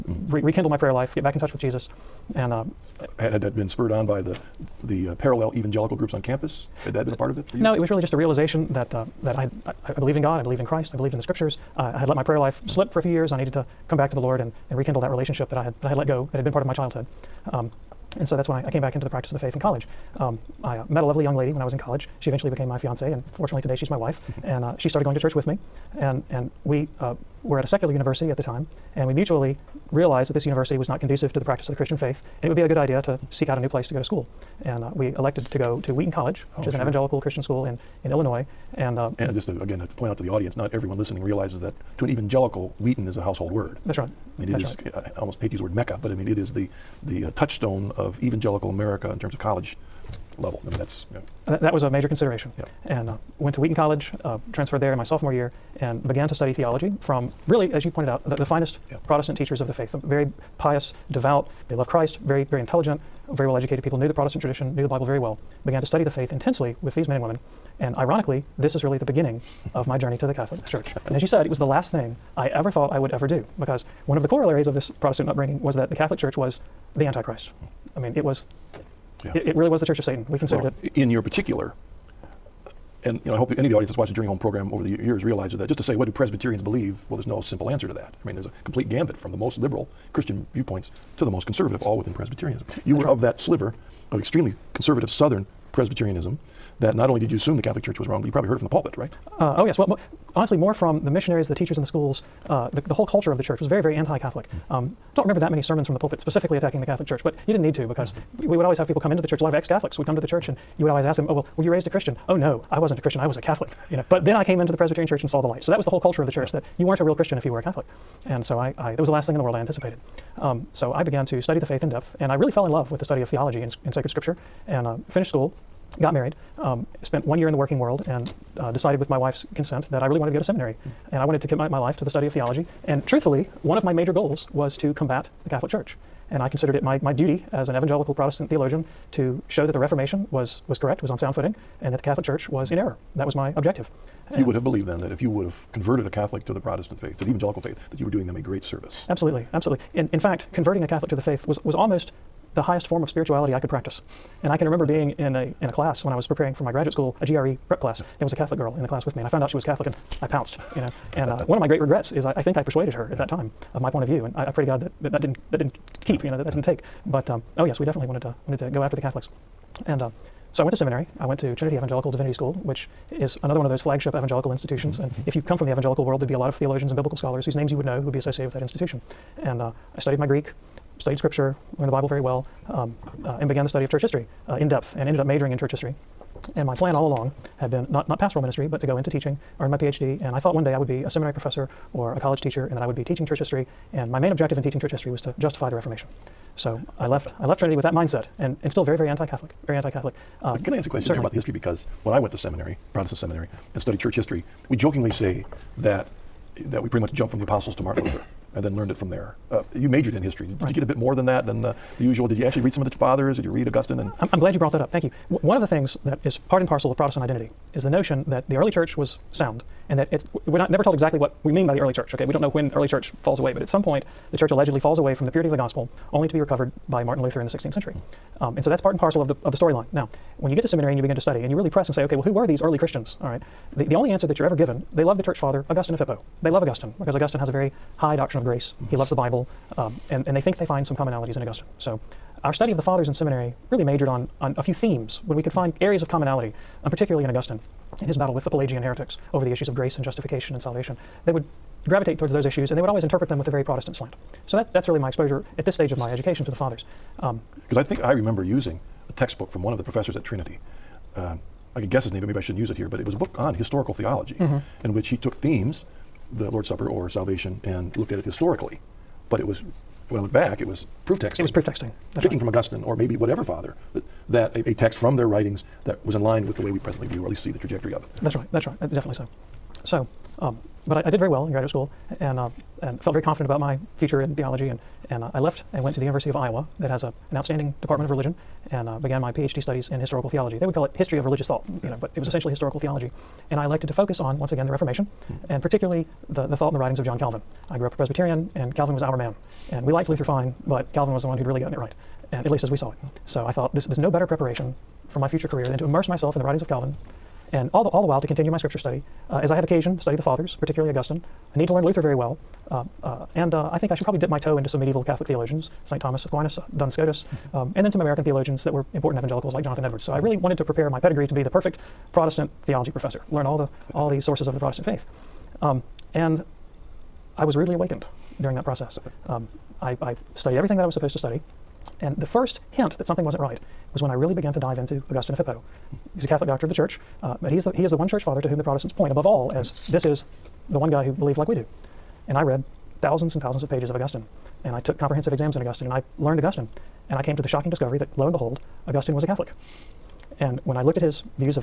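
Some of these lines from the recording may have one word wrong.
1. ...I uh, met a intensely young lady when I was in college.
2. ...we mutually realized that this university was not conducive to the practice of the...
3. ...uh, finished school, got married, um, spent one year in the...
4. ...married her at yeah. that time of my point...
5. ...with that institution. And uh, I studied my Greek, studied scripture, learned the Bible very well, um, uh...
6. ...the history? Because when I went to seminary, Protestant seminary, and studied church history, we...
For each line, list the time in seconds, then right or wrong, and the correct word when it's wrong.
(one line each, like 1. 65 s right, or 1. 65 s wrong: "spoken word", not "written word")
1. 20 s wrong: "lovely", not "intensely"
2. 29 s right
3. 124 s right
4. 162 s wrong: "persuaded", not "married"
5. 178 s right
6. 201 s right.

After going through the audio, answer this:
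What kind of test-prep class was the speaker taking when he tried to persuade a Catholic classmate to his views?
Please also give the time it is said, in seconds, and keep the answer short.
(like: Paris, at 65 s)
GRE prep class, at 157 s.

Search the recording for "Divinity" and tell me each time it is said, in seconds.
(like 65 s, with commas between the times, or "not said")
172 s.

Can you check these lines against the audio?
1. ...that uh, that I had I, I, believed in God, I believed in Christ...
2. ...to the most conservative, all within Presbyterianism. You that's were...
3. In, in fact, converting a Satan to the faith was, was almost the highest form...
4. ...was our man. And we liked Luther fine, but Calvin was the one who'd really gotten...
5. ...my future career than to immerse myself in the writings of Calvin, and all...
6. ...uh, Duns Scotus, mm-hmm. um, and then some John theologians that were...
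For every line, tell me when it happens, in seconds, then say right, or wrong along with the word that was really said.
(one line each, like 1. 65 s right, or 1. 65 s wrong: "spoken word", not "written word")
1. 8 s right
2. 91 s right
3. 149 s wrong: "Catholic", not "Satan"
4. 298 s right
5. 305 s right
6. 316 s wrong: "American", not "John".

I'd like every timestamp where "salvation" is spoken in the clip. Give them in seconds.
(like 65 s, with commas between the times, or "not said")
250 s, 267 s.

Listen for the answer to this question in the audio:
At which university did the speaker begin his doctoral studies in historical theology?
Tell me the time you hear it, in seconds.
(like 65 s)
286 s.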